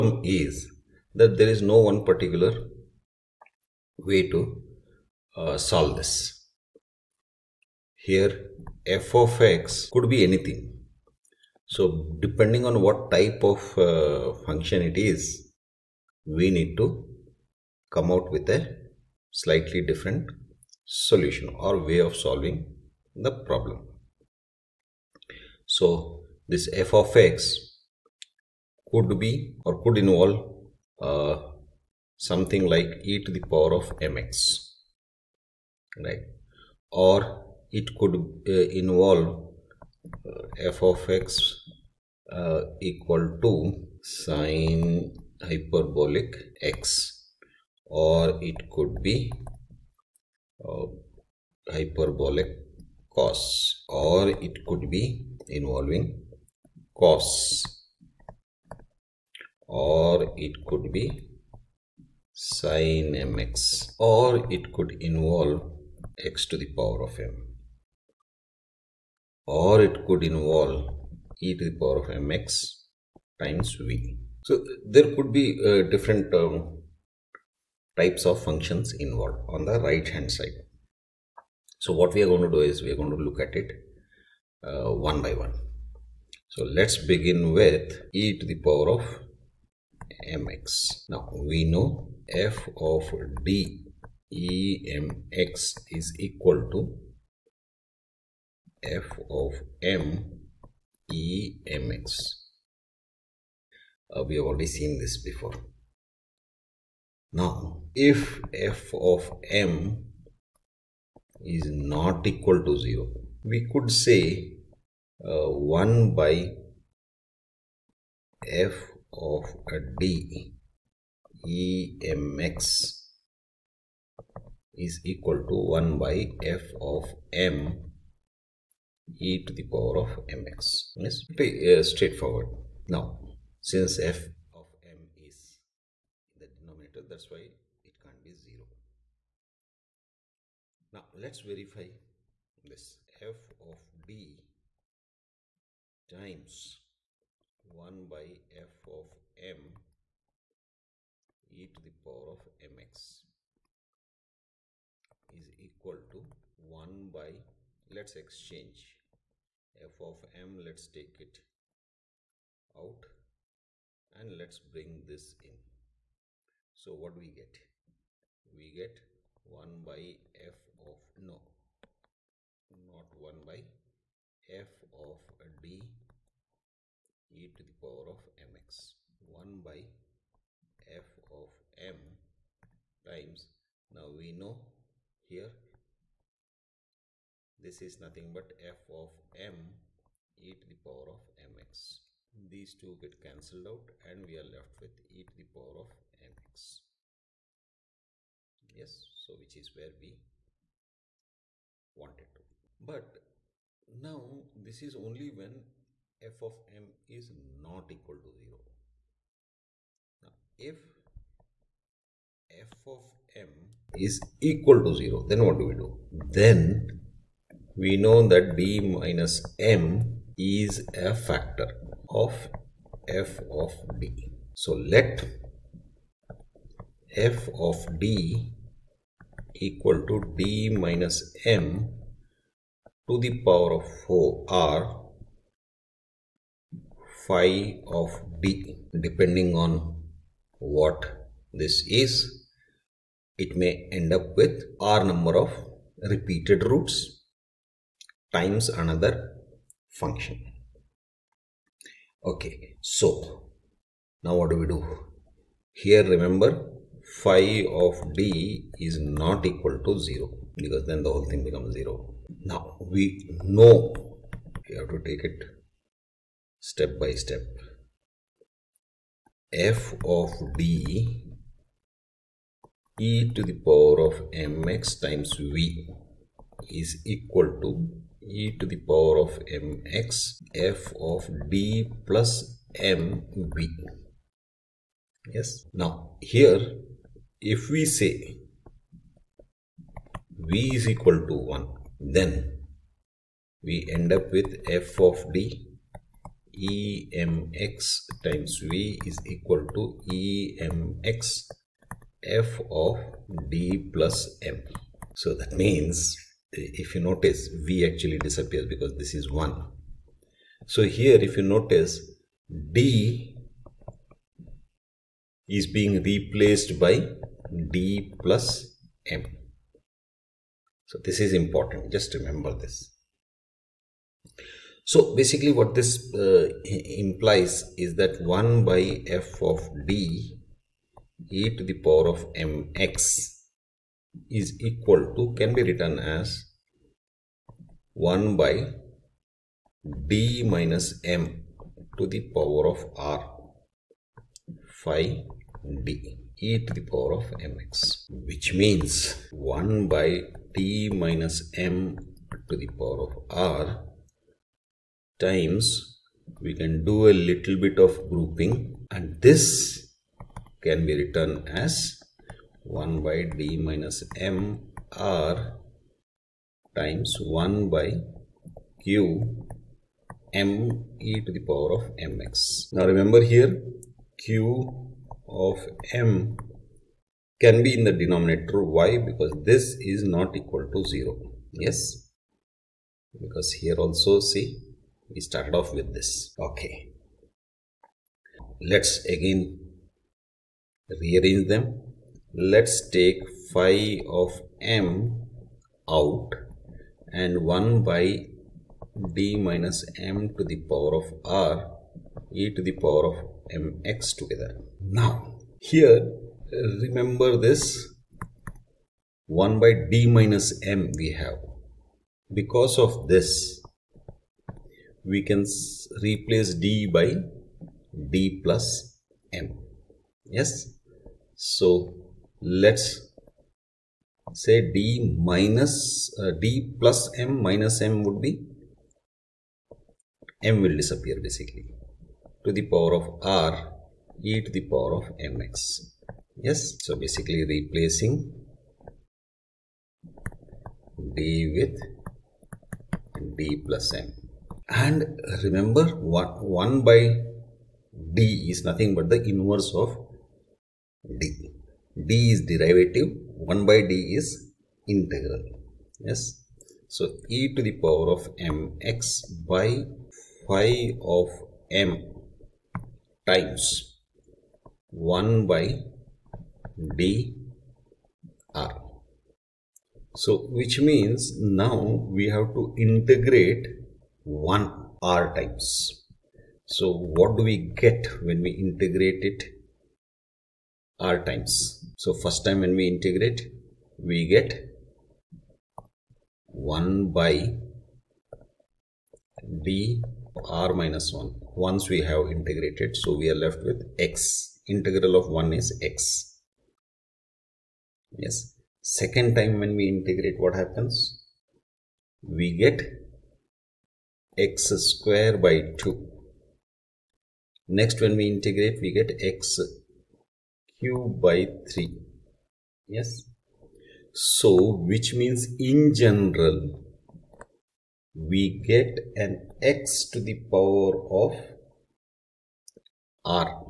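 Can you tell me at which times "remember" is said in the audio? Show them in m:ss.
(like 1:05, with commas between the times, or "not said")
4:16, 5:22, 6:12, 6:46, 7:25.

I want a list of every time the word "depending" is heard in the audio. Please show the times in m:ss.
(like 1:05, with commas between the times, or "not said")
0:12, 3:59.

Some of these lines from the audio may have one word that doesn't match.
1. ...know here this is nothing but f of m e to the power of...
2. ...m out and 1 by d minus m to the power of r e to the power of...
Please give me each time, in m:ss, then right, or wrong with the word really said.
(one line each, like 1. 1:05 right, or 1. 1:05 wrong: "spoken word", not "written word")
1. 3:04 right
2. 6:34 right.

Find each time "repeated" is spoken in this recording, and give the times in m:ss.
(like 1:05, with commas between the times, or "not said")
4:06.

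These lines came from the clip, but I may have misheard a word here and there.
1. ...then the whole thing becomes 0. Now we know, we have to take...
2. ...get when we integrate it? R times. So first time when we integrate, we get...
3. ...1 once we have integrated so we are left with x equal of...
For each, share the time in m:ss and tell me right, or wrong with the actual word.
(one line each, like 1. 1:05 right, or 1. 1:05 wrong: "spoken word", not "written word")
1. 4:20 right
2. 7:57 right
3. 8:11 wrong: "integral", not "equal".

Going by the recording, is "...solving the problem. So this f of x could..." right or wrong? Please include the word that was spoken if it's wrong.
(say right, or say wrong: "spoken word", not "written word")
right.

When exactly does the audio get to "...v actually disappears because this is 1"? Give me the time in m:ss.
5:07.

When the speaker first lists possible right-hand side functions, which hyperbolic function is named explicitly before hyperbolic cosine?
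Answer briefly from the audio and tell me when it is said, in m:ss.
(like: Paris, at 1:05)
sine hyperbolic x, at 0:44.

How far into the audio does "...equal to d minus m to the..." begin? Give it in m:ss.
3:49.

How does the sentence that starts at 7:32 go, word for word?
d is derivative, 1 by d is integral.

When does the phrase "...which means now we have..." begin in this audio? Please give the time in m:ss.
7:50.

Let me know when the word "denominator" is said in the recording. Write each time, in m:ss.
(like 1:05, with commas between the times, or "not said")
2:16, 6:18.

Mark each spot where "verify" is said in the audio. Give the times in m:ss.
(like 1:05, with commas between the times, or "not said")
2:21.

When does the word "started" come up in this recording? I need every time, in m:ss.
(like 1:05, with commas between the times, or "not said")
6:25.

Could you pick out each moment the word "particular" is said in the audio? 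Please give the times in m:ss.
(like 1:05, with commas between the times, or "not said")
0:02.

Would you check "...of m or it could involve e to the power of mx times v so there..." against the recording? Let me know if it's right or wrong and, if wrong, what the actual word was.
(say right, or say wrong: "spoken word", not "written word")
right.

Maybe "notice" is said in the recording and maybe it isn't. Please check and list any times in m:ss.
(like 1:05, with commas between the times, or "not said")
5:07, 5:11.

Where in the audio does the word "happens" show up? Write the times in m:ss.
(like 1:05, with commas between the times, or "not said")
8:20.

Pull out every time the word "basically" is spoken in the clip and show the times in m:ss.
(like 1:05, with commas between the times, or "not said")
5:25, 7:11, 7:16.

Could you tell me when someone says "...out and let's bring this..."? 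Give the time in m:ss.
2:42.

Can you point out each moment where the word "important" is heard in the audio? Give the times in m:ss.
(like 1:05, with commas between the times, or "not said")
5:21.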